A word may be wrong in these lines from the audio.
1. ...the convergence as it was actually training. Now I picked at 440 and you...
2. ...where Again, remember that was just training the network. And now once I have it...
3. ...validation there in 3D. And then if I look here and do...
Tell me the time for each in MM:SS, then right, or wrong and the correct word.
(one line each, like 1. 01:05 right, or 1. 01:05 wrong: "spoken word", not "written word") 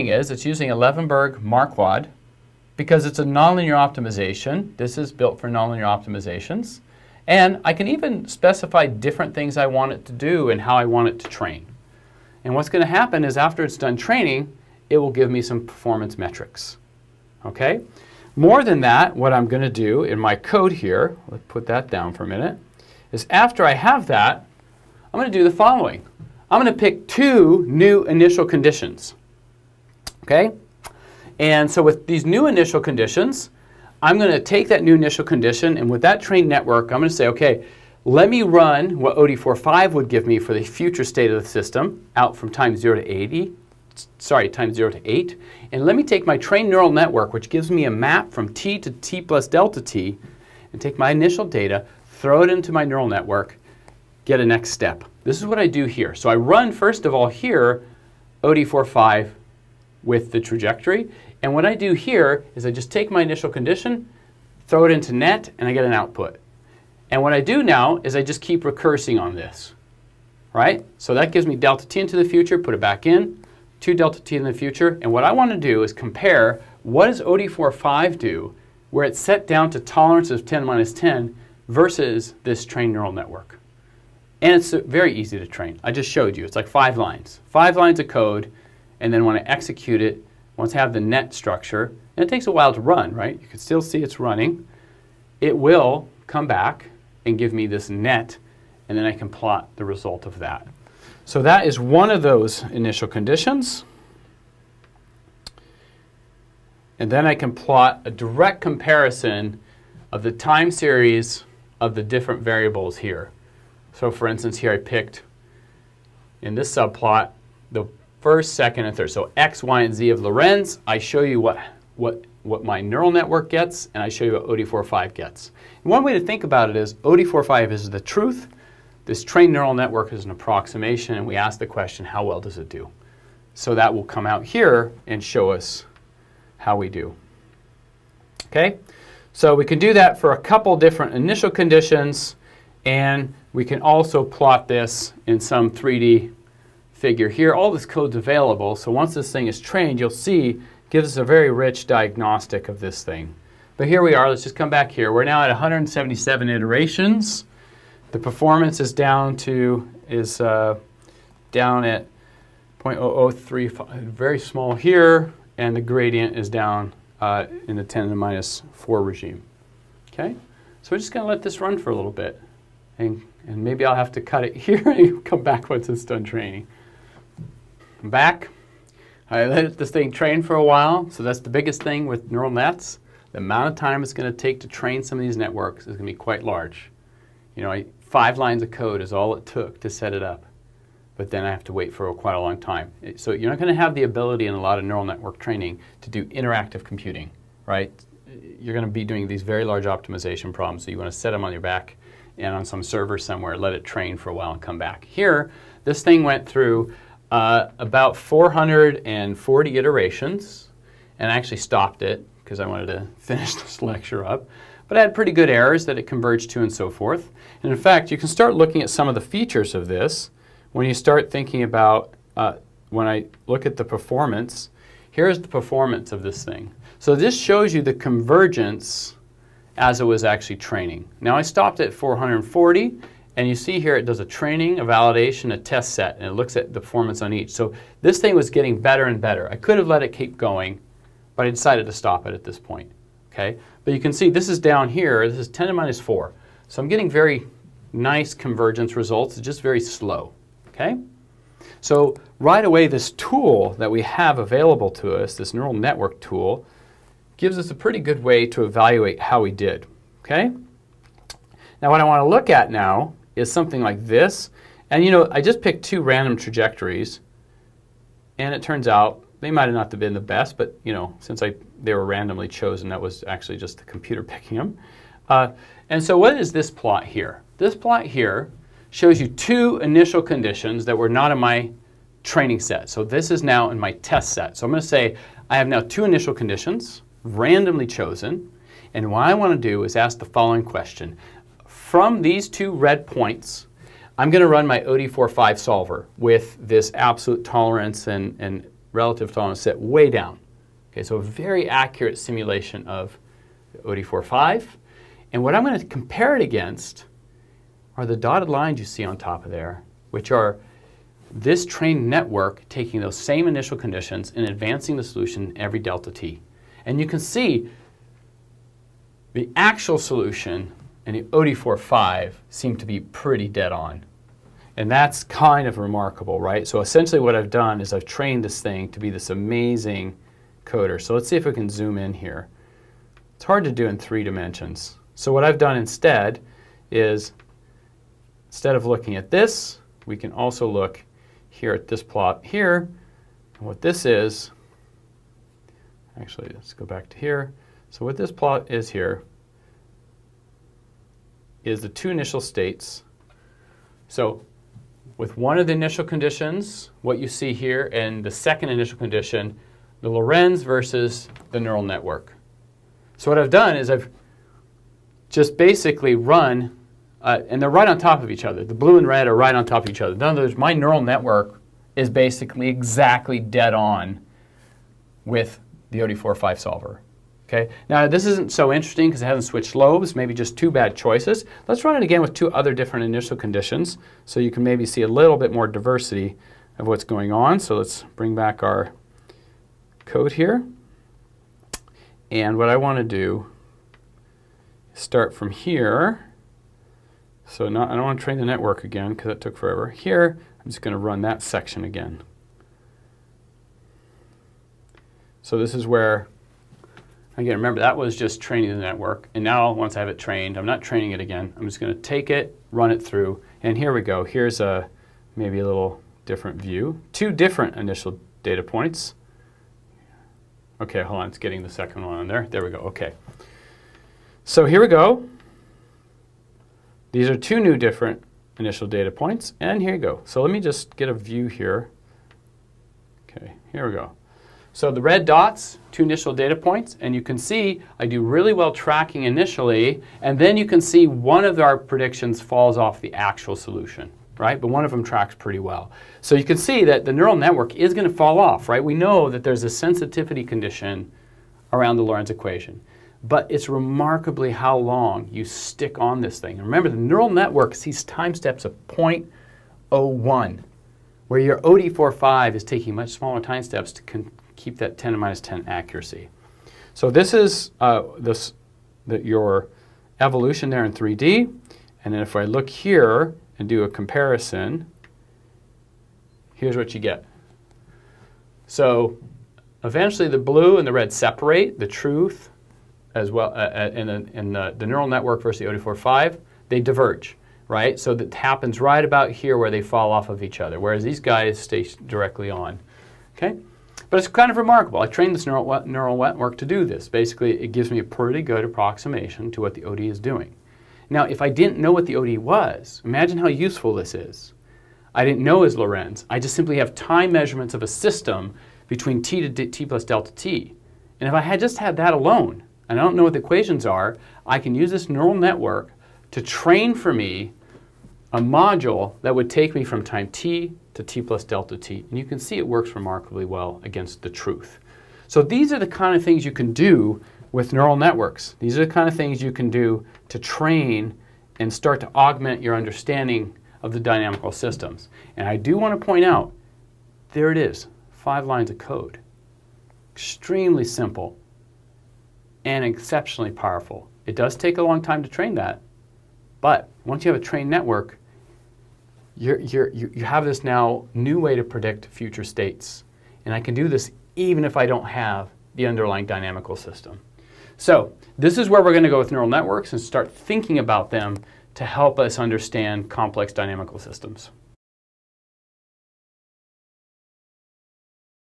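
1. 03:47 wrong: "stopped", not "picked"
2. 06:45 right
3. 07:50 wrong: "evolution", not "validation".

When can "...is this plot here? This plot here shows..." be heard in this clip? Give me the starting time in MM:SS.
04:36.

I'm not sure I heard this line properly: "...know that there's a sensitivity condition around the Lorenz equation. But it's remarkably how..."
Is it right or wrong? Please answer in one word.
right.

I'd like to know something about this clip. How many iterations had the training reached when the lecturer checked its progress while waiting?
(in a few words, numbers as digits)
177.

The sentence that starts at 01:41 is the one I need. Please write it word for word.
So that is one of those initial conditions.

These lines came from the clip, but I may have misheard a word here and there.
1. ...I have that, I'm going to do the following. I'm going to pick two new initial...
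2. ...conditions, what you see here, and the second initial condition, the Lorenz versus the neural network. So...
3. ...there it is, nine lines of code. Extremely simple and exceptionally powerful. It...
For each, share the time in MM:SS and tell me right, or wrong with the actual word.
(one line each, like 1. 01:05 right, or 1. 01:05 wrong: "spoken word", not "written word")
1. 00:23 right
2. 05:56 right
3. 08:57 wrong: "five", not "nine".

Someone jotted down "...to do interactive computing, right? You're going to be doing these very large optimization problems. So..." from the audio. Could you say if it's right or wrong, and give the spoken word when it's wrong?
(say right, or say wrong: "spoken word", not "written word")
right.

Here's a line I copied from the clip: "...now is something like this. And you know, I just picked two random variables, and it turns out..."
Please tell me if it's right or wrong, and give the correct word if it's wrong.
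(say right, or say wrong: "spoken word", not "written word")
wrong: "trajectories", not "variables".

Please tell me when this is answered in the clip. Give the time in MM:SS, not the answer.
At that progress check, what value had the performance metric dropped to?
02:42.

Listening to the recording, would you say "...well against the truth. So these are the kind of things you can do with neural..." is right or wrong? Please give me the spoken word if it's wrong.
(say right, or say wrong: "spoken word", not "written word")
right.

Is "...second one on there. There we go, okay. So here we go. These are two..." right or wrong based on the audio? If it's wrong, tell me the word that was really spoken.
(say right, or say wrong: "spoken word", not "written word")
right.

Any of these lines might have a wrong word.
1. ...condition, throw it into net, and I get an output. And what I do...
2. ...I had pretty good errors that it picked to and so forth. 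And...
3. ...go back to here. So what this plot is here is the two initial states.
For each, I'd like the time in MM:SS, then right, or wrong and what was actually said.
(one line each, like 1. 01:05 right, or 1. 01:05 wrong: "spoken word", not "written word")
1. 01:03 right
2. 03:34 wrong: "converged", not "picked"
3. 05:46 right.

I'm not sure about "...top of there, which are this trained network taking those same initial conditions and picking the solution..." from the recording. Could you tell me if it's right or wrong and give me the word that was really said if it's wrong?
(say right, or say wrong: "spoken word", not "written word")
wrong: "advancing", not "picking".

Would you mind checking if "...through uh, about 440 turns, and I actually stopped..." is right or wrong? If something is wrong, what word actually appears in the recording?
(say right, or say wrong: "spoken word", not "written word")
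wrong: "iterations", not "turns".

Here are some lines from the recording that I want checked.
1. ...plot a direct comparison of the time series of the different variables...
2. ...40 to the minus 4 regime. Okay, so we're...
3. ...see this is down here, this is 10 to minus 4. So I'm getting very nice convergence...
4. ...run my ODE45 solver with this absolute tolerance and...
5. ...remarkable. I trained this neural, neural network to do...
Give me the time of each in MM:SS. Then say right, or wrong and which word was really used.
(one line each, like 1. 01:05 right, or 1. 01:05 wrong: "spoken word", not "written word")
1. 01:47 right
2. 02:47 wrong: "10", not "40"
3. 04:04 right
4. 04:54 right
5. 08:14 right.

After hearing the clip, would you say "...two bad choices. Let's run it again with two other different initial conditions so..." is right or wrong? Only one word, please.
right.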